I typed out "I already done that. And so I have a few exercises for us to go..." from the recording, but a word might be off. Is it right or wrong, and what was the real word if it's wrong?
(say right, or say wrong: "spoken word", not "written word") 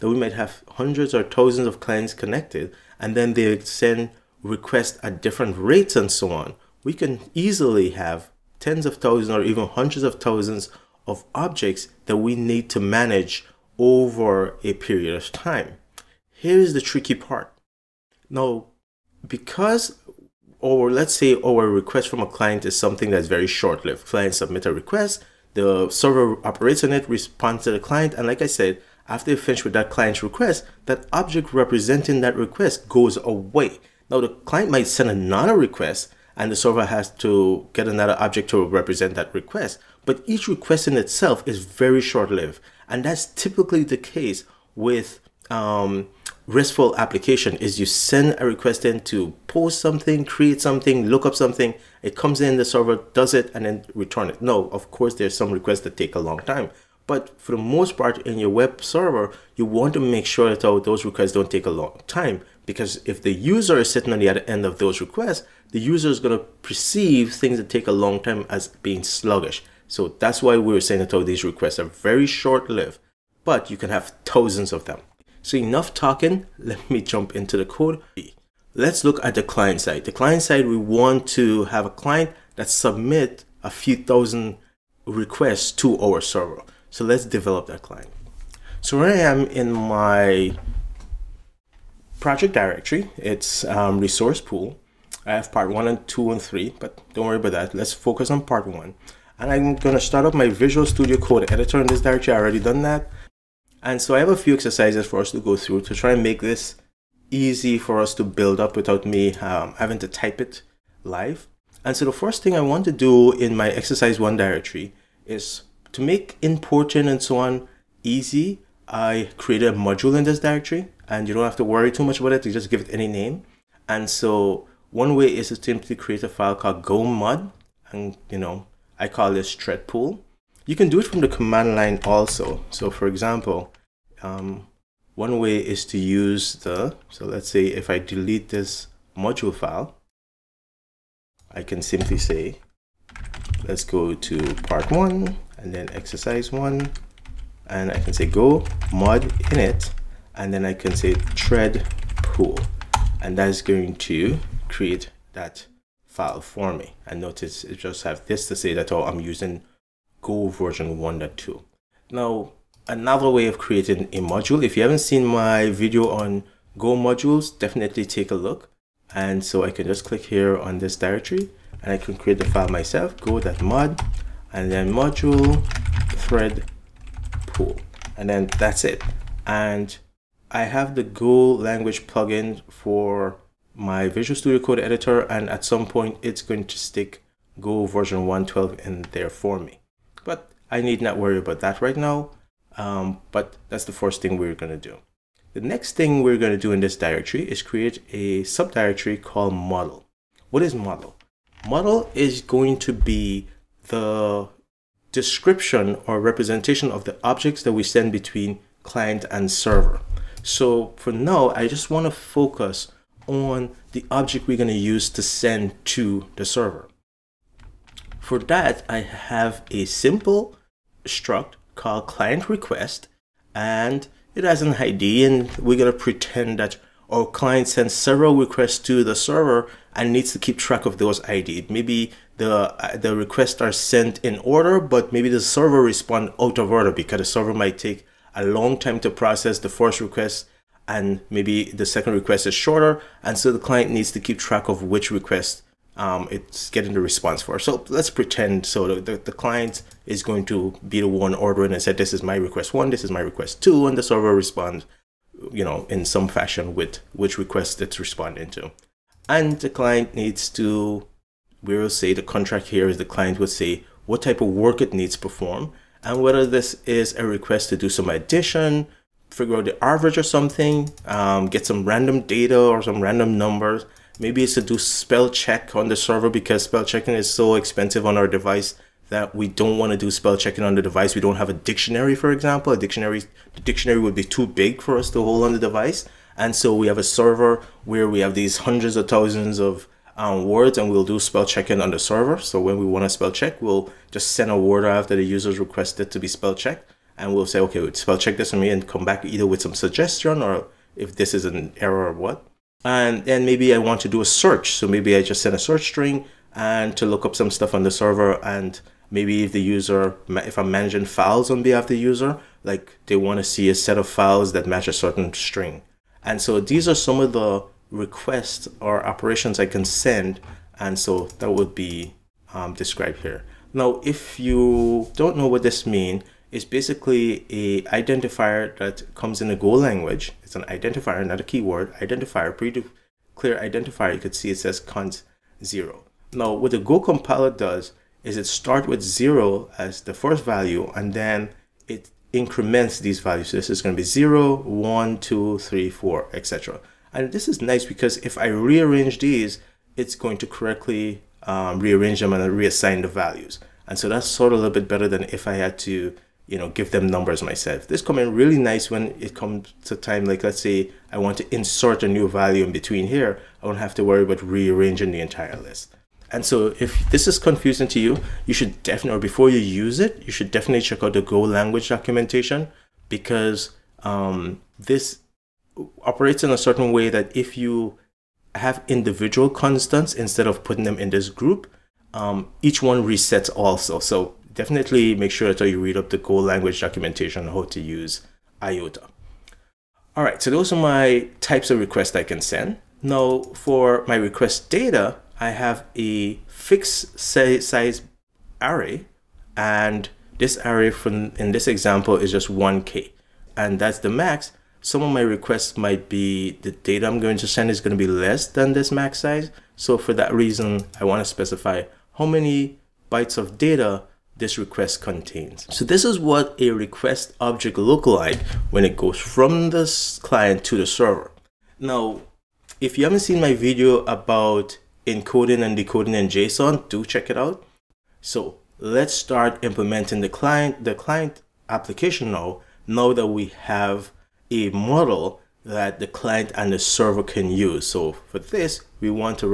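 right.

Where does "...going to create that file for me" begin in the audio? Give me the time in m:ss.
2:33.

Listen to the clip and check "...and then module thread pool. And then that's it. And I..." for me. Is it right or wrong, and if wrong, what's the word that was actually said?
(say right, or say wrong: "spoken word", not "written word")
right.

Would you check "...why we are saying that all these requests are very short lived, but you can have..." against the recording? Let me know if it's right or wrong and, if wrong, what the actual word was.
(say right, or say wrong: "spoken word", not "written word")
right.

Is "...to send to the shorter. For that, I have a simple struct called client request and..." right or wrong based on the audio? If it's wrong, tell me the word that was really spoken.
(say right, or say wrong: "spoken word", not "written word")
wrong: "server", not "shorter".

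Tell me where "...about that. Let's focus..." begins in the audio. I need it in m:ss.
1:37.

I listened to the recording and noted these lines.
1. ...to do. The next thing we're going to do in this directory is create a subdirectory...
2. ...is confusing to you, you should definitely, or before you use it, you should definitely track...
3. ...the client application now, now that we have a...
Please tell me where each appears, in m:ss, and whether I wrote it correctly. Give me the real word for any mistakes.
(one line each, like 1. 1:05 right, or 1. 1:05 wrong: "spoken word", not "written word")
1. 3:14 right
2. 6:07 wrong: "check", not "track"
3. 7:10 right.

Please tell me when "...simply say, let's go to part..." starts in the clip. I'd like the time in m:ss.
2:21.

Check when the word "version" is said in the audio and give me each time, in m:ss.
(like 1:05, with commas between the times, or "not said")
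2:40, 3:07.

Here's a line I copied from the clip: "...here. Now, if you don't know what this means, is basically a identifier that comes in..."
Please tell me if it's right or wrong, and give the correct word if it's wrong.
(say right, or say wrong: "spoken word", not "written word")
right.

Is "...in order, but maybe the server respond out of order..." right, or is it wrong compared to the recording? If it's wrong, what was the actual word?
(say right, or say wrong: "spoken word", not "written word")
right.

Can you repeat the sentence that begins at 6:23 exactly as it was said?
So definitely make sure that you read up the Go language documentation on how to use IOTA.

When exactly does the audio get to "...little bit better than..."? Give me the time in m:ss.
5:54.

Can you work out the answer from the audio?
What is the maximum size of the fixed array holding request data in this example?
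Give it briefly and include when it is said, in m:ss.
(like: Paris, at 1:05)
1k, at 6:42.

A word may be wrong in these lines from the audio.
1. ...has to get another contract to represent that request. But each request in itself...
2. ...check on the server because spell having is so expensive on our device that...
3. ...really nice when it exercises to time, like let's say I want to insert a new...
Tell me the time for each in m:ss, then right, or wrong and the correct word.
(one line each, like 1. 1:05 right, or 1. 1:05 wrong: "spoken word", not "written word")
1. 0:36 wrong: "object", not "contract"
2. 4:35 wrong: "checking", not "having"
3. 5:58 wrong: "comes", not "exercises".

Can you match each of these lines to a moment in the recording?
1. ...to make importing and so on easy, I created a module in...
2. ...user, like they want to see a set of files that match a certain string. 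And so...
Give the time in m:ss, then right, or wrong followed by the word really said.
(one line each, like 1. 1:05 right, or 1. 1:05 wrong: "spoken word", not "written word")
1. 1:55 right
2. 5:11 right.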